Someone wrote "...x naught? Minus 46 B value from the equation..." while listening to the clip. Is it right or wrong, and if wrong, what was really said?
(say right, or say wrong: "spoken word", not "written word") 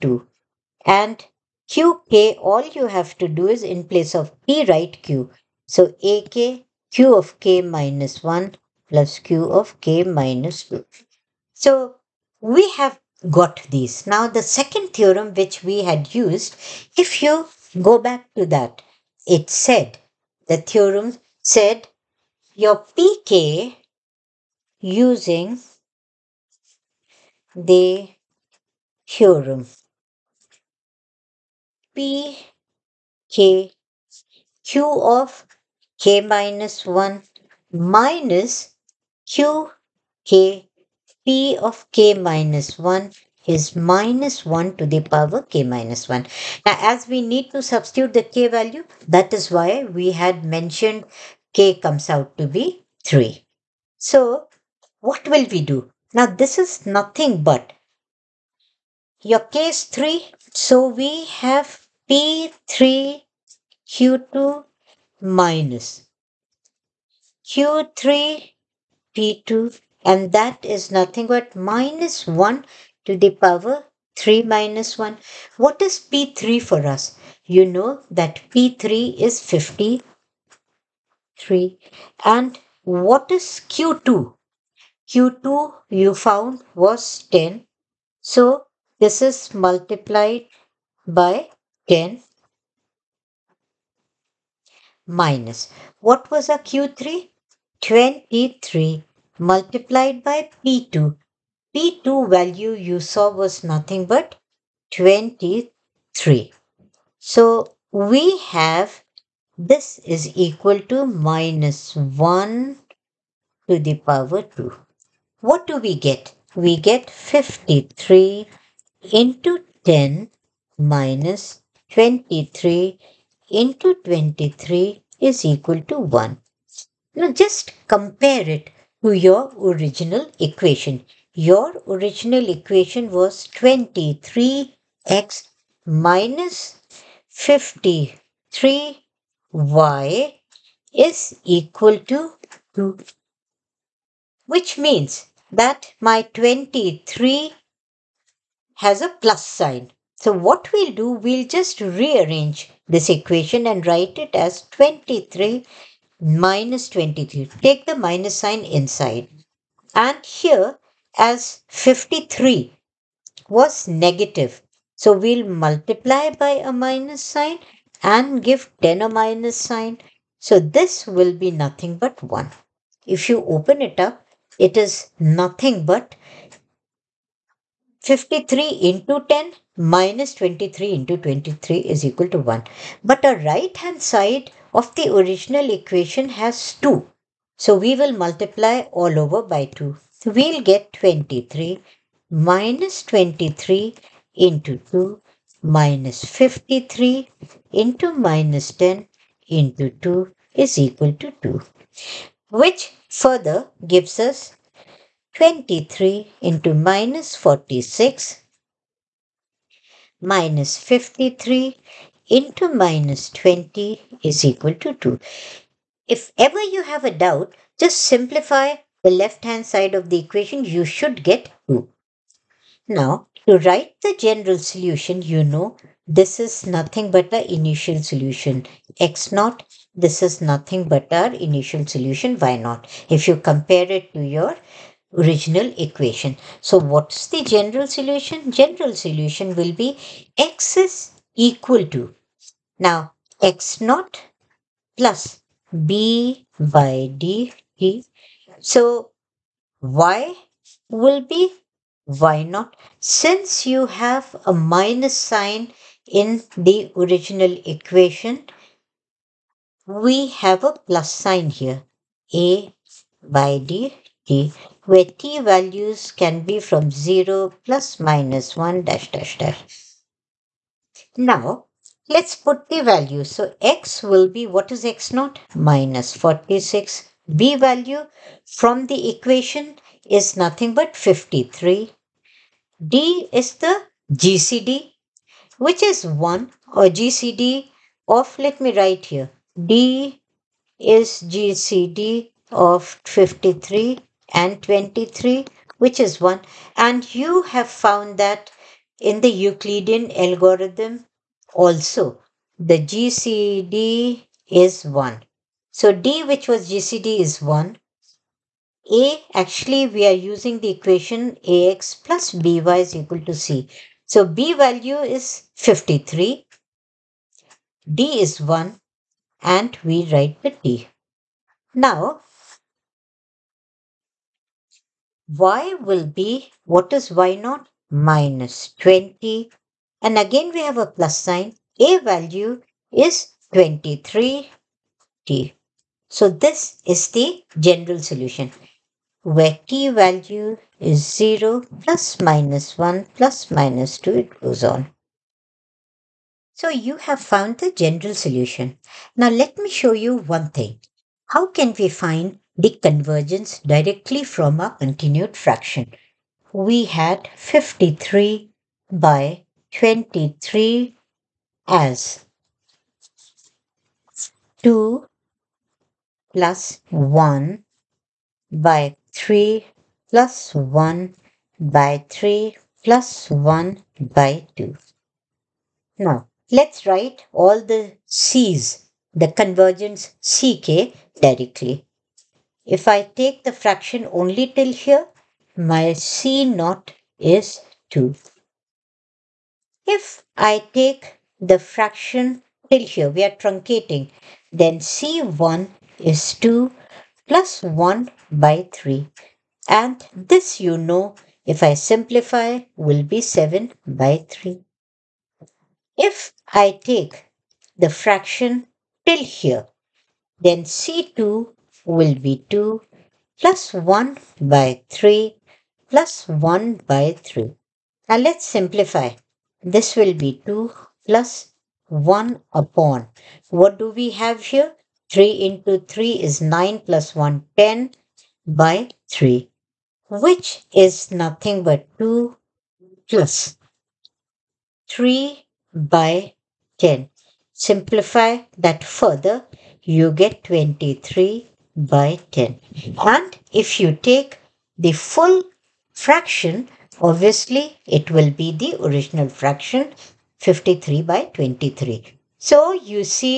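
right.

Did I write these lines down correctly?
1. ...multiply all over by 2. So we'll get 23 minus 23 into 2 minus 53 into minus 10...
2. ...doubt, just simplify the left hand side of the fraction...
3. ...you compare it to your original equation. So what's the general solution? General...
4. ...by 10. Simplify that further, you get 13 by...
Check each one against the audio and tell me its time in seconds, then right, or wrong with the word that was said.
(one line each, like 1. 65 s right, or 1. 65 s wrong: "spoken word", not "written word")
1. 188 s right
2. 217 s wrong: "equation", not "fraction"
3. 233 s right
4. 435 s wrong: "23", not "13".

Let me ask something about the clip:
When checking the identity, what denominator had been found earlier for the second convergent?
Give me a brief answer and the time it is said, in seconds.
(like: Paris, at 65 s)
10, at 85 s.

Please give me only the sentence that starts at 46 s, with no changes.
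Now as we need to substitute the k value, that is why we had mentioned k comes out to be 3.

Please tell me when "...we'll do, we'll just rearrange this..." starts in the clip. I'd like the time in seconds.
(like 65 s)
150 s.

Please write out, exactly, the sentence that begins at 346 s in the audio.
So you have found the general solution.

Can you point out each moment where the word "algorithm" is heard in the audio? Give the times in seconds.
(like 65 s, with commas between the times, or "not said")
300 s.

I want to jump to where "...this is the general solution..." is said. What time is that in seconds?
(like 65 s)
336 s.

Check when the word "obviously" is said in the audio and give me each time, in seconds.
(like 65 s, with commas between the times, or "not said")
447 s.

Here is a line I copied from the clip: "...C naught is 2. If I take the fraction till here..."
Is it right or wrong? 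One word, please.
right.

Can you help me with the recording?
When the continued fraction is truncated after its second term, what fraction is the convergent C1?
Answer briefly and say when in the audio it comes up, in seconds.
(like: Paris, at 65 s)
7/3, at 403 s.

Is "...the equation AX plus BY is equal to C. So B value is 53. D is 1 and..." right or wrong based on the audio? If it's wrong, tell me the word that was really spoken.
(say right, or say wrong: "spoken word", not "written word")
right.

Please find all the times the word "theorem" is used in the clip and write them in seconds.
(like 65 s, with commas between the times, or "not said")
14 s, 20 s, 29 s.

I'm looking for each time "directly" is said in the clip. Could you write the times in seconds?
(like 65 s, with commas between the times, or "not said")
353 s, 381 s.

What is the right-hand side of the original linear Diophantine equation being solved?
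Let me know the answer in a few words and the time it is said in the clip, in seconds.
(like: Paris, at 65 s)
2, at 133 s.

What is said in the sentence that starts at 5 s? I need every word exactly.
So AK Q of K minus 1 plus Q of K minus 2.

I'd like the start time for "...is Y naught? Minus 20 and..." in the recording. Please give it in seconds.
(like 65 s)
326 s.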